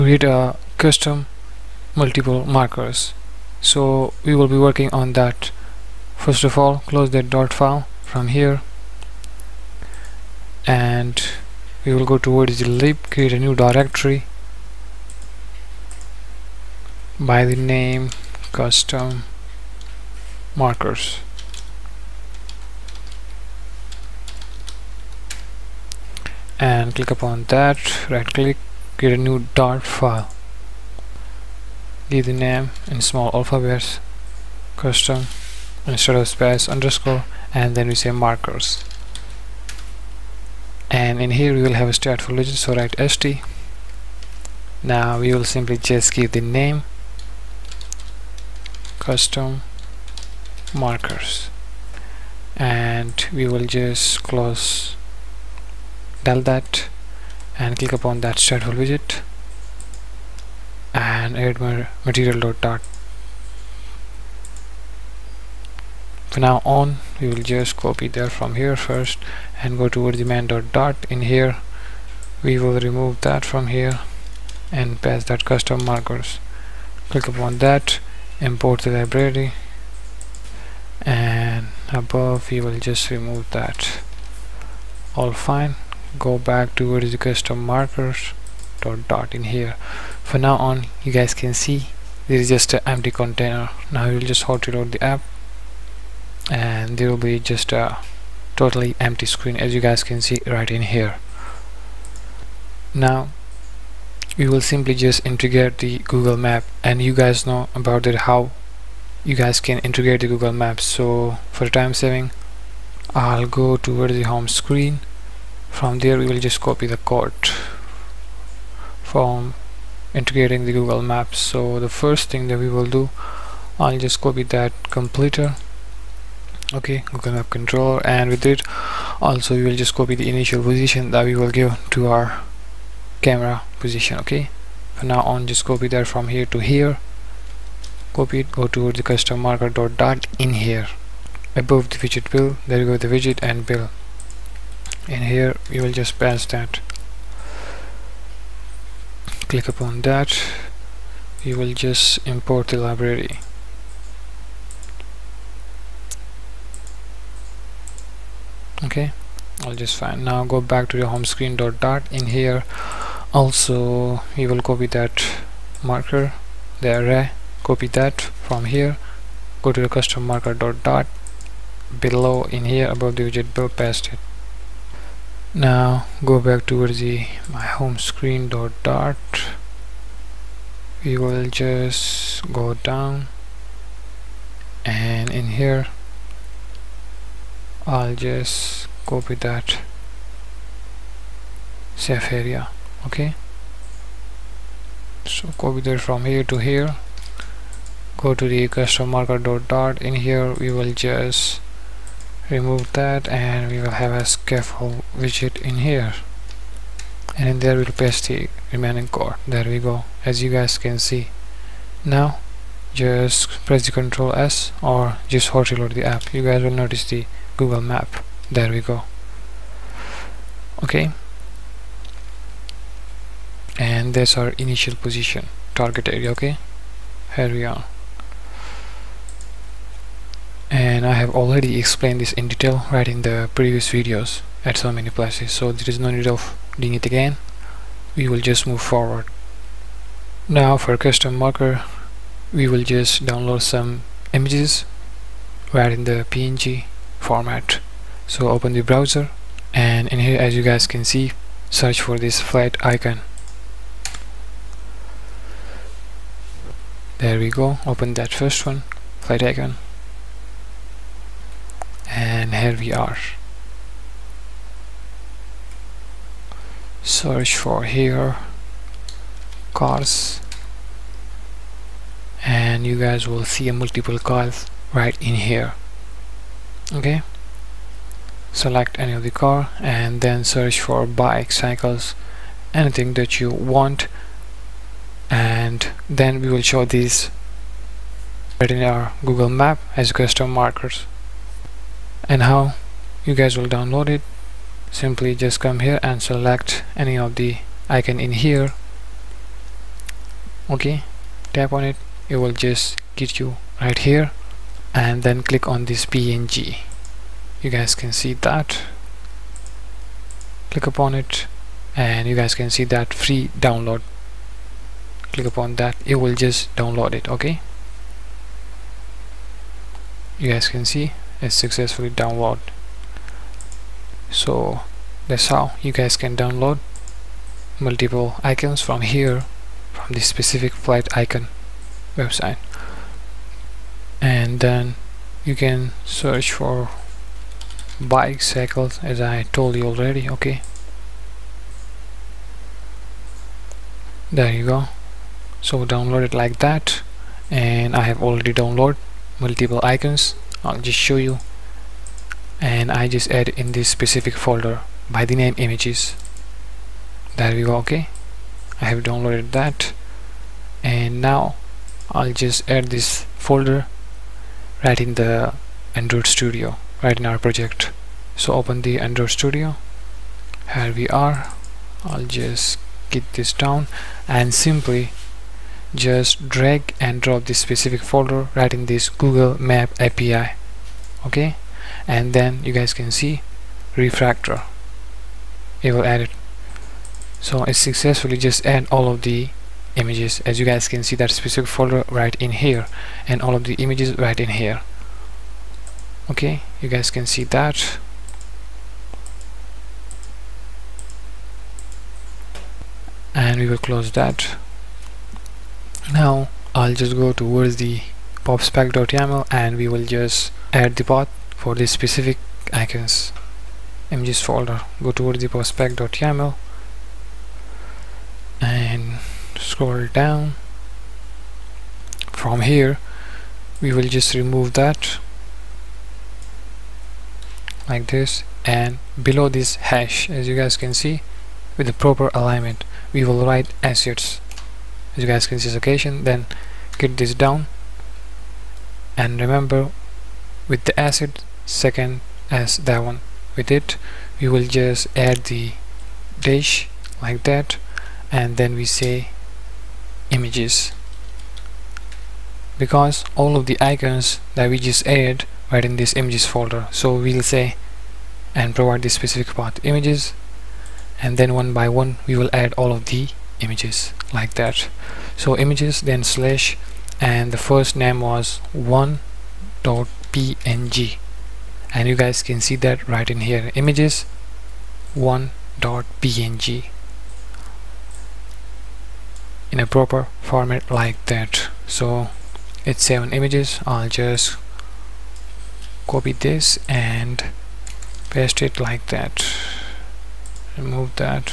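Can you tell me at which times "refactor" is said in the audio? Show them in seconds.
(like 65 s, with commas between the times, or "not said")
383 s.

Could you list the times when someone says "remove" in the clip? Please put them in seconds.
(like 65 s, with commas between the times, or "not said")
72 s, 83 s, 202 s, 424 s, 490 s.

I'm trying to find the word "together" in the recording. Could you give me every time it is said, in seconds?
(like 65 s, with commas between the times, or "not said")
not said.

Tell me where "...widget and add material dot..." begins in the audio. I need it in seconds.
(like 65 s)
58 s.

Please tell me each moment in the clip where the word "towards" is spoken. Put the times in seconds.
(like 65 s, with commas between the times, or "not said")
12 s, 69 s, 86 s, 113 s, 176 s, 407 s, 415 s.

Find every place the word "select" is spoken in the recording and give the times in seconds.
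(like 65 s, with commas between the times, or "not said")
278 s, 296 s.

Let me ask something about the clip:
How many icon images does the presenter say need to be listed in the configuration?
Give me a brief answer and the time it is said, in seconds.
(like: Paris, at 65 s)
7, at 483 s.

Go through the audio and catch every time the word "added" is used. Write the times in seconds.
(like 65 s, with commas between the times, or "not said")
455 s.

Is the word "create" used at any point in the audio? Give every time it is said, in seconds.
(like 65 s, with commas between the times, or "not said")
13 s, 28 s.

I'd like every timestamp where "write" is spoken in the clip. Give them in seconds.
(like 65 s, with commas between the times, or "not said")
42 s, 433 s.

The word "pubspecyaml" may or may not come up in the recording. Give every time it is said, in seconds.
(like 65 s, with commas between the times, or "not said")
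408 s, 415 s.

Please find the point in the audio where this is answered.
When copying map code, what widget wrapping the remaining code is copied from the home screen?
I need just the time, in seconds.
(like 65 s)
192 s.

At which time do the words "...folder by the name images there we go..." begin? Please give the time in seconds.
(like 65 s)
354 s.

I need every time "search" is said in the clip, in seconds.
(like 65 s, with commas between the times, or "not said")
251 s, 267 s, 280 s, 336 s.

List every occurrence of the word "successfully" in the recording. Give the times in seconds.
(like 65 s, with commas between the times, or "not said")
321 s, 387 s.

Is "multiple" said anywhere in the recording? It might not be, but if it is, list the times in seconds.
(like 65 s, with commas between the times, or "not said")
1 s, 273 s, 327 s, 349 s.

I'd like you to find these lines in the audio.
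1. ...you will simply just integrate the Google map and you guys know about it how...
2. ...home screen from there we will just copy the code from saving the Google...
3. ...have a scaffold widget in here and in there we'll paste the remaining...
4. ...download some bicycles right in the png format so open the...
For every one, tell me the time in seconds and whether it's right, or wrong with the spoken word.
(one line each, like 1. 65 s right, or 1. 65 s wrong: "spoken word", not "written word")
1. 104 s right
2. 114 s wrong: "integrating", not "saving"
3. 204 s right
4. 243 s wrong: "images", not "bicycles".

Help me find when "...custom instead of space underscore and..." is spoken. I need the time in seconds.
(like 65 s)
34 s.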